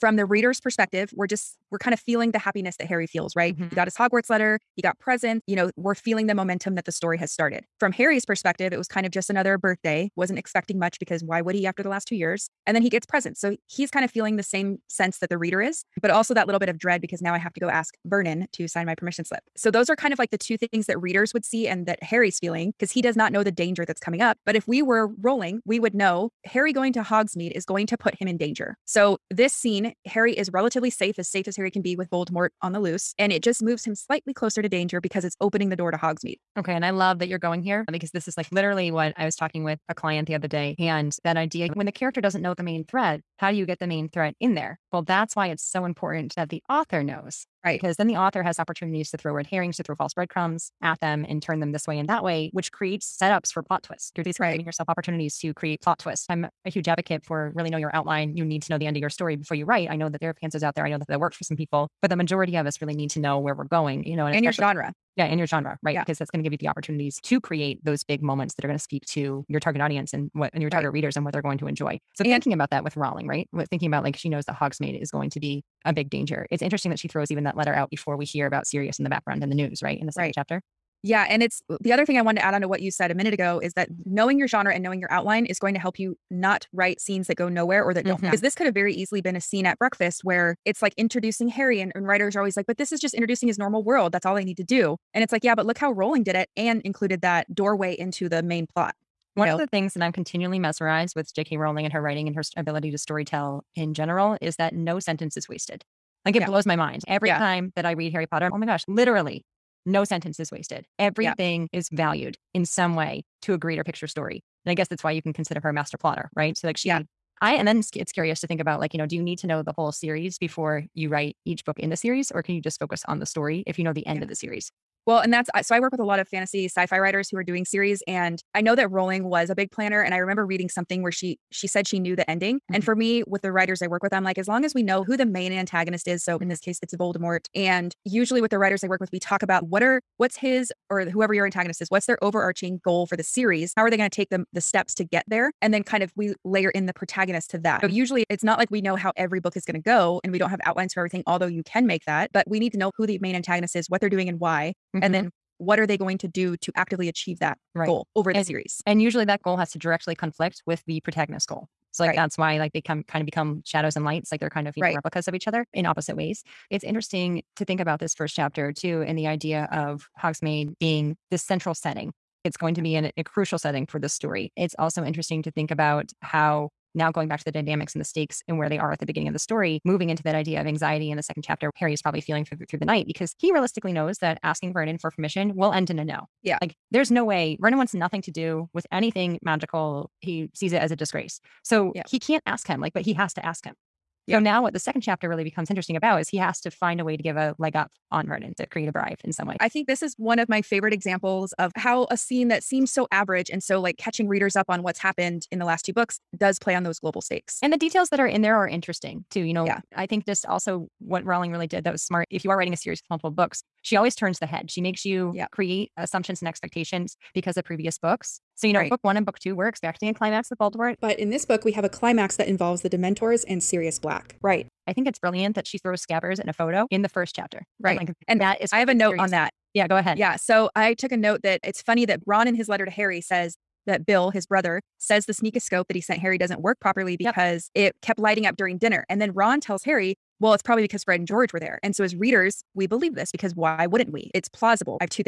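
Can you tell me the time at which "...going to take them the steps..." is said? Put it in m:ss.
2:23.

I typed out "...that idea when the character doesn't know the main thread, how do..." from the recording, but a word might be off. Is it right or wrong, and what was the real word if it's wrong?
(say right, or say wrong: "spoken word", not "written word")
right.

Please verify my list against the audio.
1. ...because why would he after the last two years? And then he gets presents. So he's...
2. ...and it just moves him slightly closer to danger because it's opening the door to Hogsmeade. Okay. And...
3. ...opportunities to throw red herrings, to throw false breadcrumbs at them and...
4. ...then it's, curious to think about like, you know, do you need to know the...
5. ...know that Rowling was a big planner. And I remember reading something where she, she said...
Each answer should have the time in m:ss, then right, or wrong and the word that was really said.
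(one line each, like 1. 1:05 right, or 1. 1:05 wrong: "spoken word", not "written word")
1. 0:10 right
2. 0:33 right
3. 0:48 right
4. 1:57 right
5. 2:08 right.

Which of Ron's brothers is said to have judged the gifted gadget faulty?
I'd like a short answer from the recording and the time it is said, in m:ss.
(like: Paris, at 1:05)
Bill, at 3:54.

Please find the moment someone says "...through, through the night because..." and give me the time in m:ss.
3:02.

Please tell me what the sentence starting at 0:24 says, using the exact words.
But if we were Rowling, we would know Harry going to Hogsmeade is going to put him in danger.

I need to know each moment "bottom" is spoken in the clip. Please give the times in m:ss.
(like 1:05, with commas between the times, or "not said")
not said.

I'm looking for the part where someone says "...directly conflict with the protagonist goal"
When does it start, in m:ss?
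2:39.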